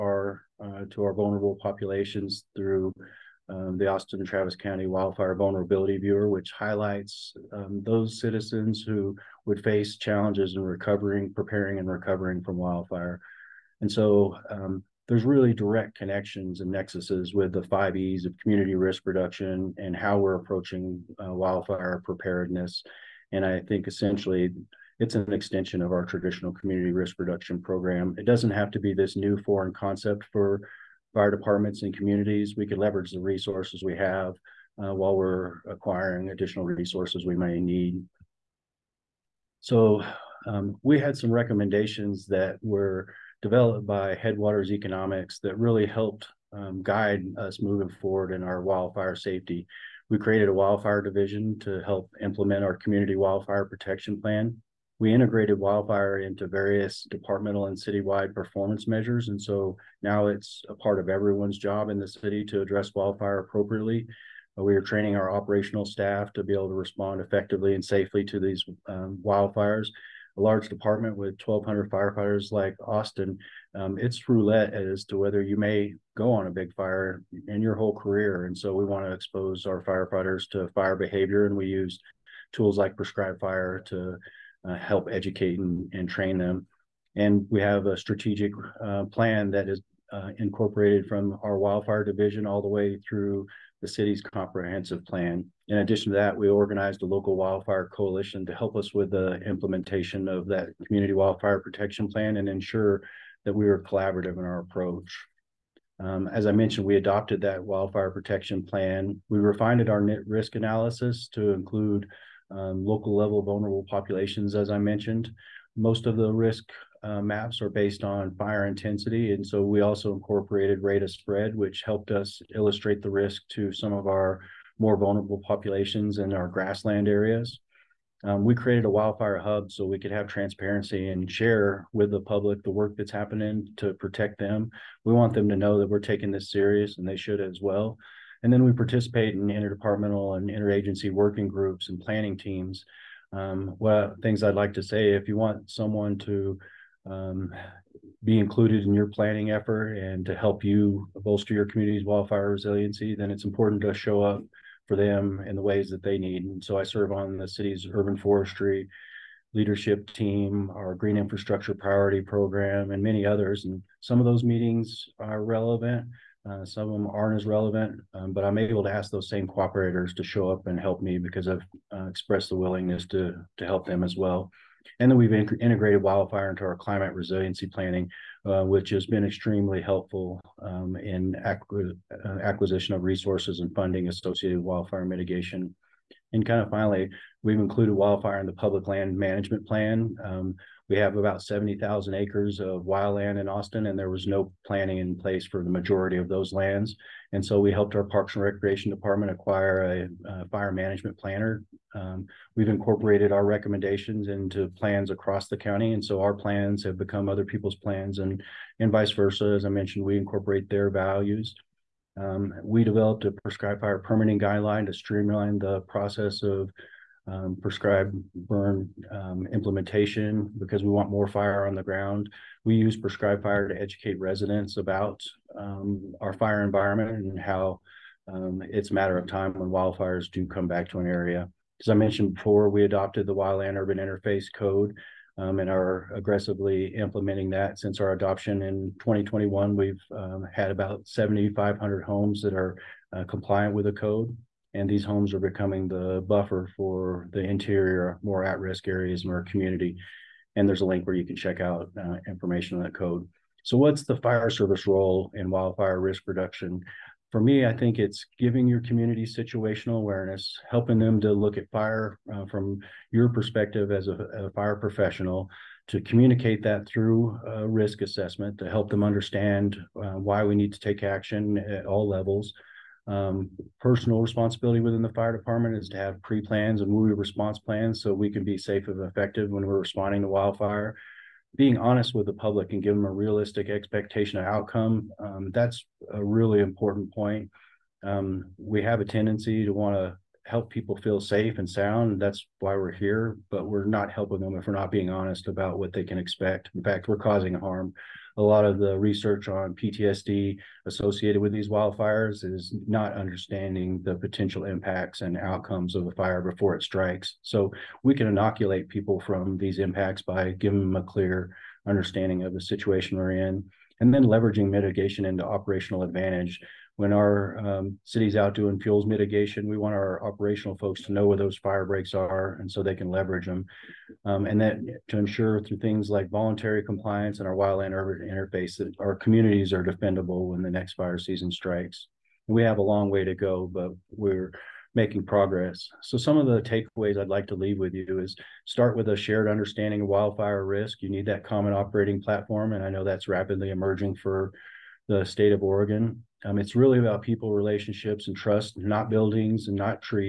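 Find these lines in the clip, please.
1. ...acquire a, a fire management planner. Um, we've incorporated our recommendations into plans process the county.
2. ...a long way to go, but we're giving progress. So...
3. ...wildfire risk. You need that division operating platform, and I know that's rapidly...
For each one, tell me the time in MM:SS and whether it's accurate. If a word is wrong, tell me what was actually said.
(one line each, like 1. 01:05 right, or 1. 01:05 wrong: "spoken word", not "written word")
1. 03:19 wrong: "across", not "process"
2. 05:32 wrong: "making", not "giving"
3. 05:40 wrong: "common", not "division".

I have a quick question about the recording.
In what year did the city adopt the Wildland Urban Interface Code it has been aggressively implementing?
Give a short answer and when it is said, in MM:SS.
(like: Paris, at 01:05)
2021, at 03:58.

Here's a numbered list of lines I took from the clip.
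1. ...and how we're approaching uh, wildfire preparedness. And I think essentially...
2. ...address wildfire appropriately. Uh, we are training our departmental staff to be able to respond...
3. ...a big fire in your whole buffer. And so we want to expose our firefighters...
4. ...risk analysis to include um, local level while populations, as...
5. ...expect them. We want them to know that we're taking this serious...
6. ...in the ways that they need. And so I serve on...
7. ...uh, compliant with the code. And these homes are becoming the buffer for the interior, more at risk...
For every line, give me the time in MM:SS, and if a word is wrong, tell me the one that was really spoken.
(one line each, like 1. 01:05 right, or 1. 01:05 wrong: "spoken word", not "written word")
1. 00:19 right
2. 01:02 wrong: "operational", not "departmental"
3. 01:16 wrong: "career", not "buffer"
4. 01:50 wrong: "vulnerable", not "while"
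5. 02:13 wrong: "protect", not "expect"
6. 02:35 right
7. 04:03 right.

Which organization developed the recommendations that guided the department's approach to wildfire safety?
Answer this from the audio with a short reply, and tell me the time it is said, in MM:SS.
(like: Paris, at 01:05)
Headwaters Economics, at 00:44.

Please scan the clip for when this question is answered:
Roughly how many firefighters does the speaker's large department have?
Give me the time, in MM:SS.
01:11.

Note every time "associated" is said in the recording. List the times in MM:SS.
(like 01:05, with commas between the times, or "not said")
03:04, 05:00.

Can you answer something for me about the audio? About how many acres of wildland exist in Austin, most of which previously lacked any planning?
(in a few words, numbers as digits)
70,000.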